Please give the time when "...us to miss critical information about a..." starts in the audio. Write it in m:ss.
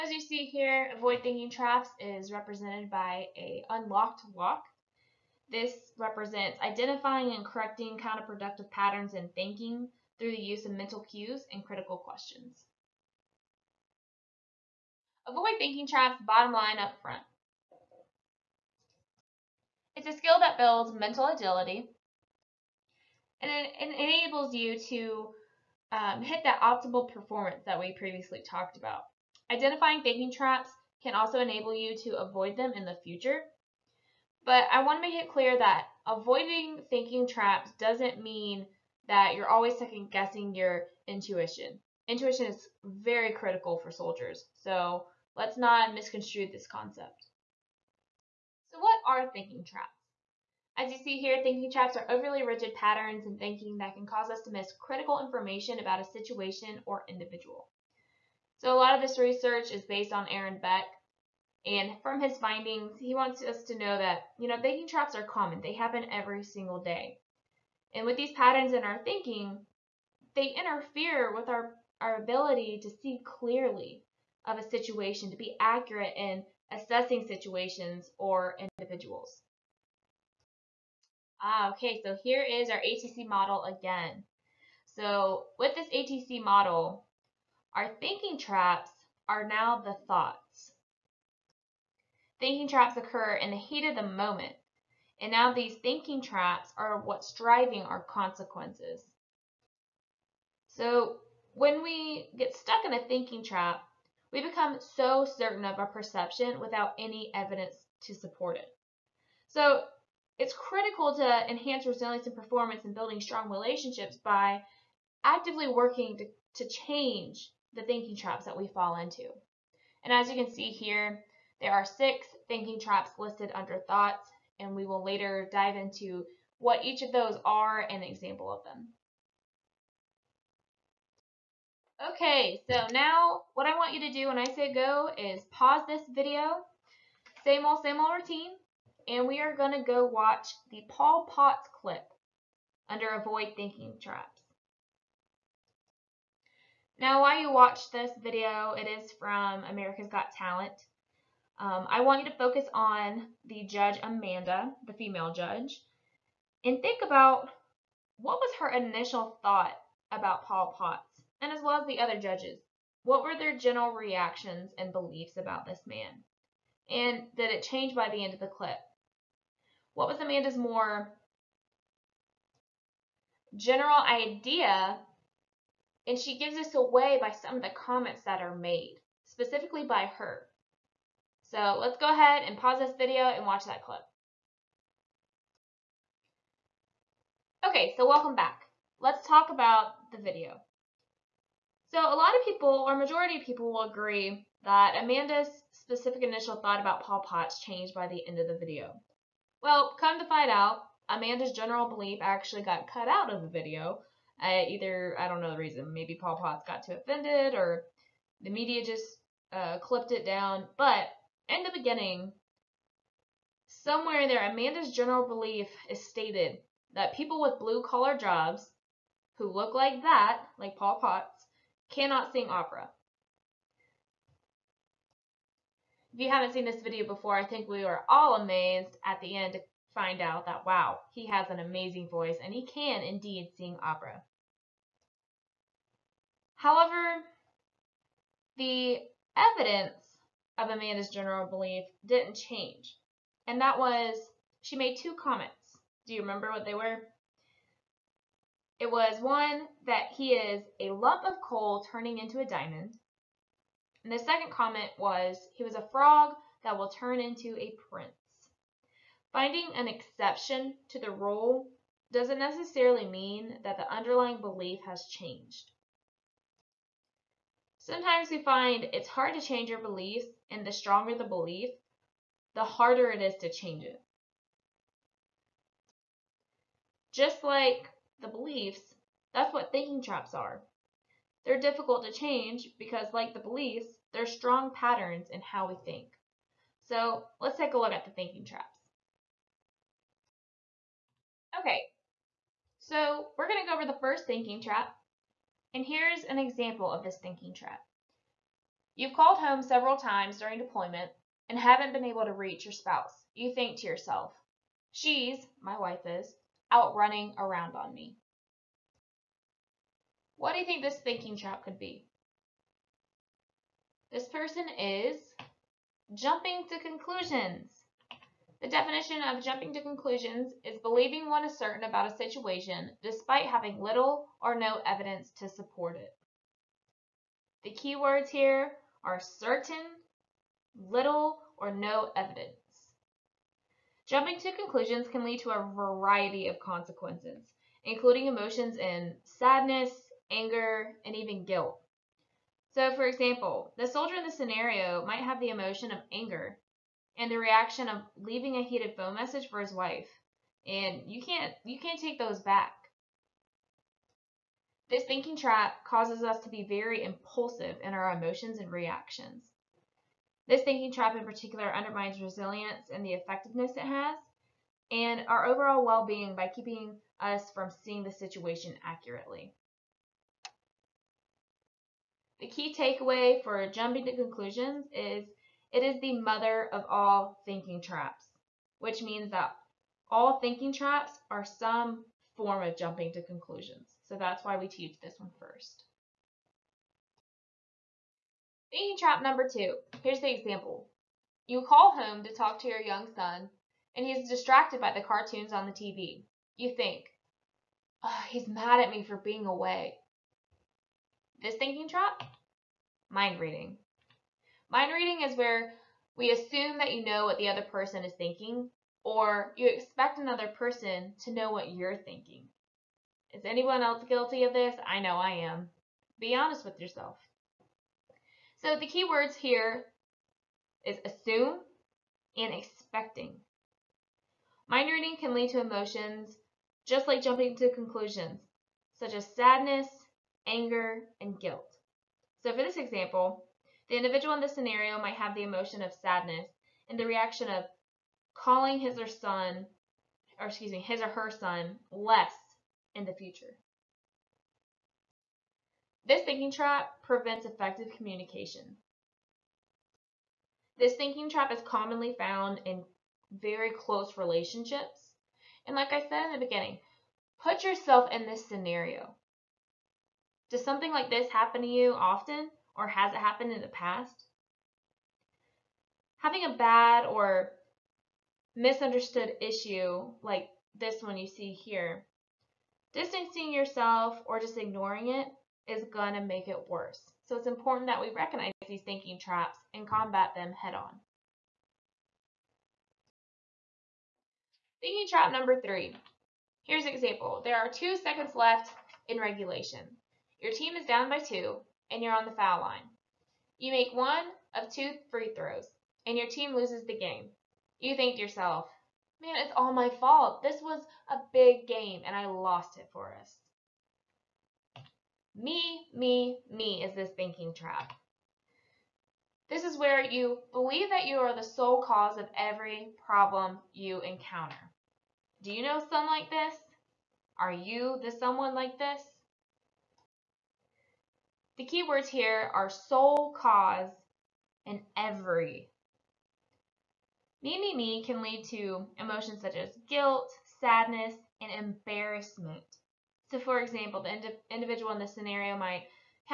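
0:54.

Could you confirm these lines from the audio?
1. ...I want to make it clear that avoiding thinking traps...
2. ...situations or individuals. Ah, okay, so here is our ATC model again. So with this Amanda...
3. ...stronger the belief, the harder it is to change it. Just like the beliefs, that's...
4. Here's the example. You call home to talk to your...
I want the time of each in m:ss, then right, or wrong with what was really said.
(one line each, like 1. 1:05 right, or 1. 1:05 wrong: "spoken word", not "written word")
1. 0:34 right
2. 1:17 wrong: "ATC", not "Amanda"
3. 4:30 right
4. 6:30 right.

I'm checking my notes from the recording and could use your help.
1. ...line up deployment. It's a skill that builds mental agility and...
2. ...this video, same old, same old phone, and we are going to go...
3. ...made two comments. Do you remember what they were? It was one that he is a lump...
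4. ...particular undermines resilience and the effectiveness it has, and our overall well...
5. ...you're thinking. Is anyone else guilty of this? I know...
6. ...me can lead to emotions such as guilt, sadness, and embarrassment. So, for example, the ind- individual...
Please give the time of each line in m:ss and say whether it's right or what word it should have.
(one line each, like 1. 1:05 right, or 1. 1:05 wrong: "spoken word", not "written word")
1. 0:16 wrong: "front", not "deployment"
2. 2:15 wrong: "routine", not "phone"
3. 4:04 right
4. 6:01 right
5. 6:51 right
6. 8:47 right.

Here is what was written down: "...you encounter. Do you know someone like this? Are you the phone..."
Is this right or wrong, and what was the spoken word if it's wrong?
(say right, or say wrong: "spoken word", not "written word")
wrong: "someone", not "phone".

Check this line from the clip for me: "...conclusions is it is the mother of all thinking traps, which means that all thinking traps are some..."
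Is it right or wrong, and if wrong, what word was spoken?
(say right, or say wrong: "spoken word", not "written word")
right.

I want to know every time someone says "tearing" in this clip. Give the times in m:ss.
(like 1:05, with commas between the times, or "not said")
not said.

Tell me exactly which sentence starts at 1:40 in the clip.
So when we get stuck in a thinking trap, we become so certain of our perception without any evidence to support it.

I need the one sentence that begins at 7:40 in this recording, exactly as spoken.
Does something like this happen to you often or has it happened in the past?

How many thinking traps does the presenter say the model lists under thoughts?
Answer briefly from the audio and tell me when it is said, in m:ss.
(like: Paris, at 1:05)
6, at 2:01.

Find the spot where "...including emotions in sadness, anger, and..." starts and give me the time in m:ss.
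5:37.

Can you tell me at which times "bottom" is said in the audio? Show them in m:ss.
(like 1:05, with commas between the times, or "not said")
0:16.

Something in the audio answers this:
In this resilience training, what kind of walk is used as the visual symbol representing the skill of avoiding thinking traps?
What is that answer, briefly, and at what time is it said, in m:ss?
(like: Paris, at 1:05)
unlocked walk, at 0:03.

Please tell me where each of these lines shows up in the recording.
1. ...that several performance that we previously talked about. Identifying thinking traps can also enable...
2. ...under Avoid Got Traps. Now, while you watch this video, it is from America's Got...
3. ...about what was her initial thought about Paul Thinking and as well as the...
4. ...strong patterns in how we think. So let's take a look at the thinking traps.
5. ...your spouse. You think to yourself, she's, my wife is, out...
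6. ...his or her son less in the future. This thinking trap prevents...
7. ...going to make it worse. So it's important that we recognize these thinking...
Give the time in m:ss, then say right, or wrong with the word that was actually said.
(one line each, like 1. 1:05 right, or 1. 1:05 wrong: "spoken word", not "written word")
1. 0:26 wrong: "optimal", not "several"
2. 2:22 wrong: "Thinking", not "Got"
3. 2:37 wrong: "Potts", not "Thinking"
4. 4:44 right
5. 5:02 right
6. 7:20 right
7. 7:55 right.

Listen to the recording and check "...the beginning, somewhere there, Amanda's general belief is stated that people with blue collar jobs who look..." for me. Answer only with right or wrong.
right.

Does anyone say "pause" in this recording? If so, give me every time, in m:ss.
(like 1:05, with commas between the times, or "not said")
2:15, 3:02.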